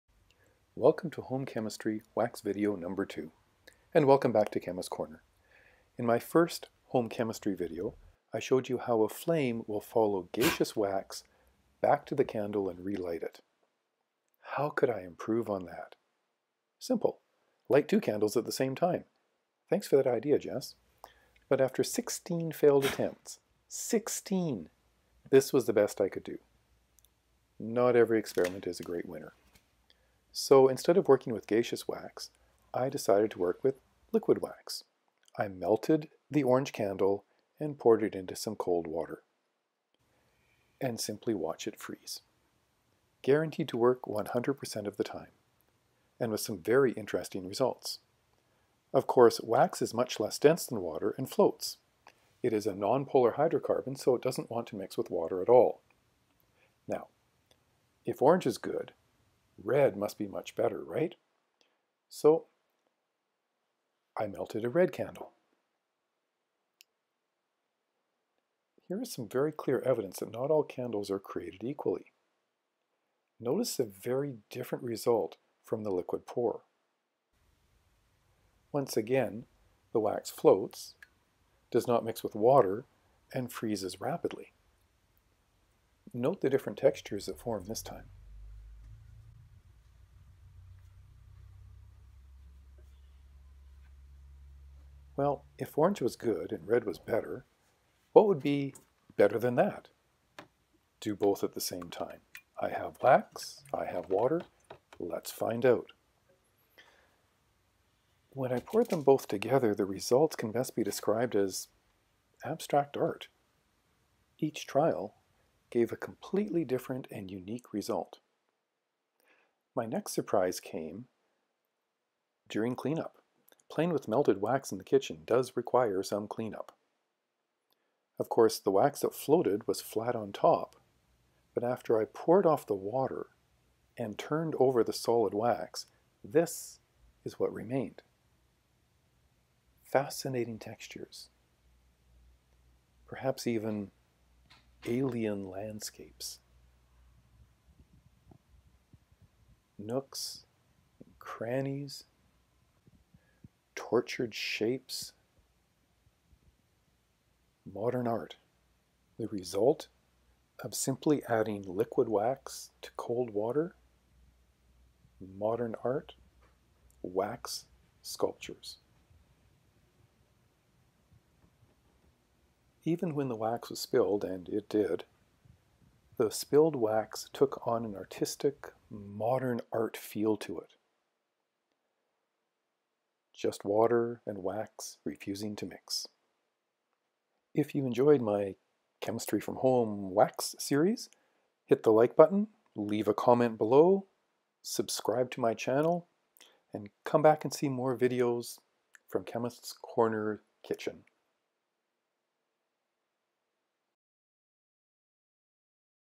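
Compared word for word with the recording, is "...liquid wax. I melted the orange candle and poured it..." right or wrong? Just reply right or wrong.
right.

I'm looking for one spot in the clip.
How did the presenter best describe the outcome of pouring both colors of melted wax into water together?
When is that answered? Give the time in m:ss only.
1:52.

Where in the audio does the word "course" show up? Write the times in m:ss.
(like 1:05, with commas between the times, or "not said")
0:49, 2:08.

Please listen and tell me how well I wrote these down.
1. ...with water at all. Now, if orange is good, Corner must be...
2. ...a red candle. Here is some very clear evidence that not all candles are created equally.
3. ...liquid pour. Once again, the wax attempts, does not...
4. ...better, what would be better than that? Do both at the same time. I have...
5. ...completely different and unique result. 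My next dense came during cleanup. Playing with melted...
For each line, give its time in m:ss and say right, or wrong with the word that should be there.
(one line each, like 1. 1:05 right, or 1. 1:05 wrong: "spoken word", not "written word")
1. 0:54 wrong: "Red", not "Corner"
2. 1:04 right
3. 1:15 wrong: "floats", not "attempts"
4. 1:36 right
5. 1:55 wrong: "surprise", not "dense".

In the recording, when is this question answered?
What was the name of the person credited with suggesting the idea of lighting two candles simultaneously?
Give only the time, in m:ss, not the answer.
0:20.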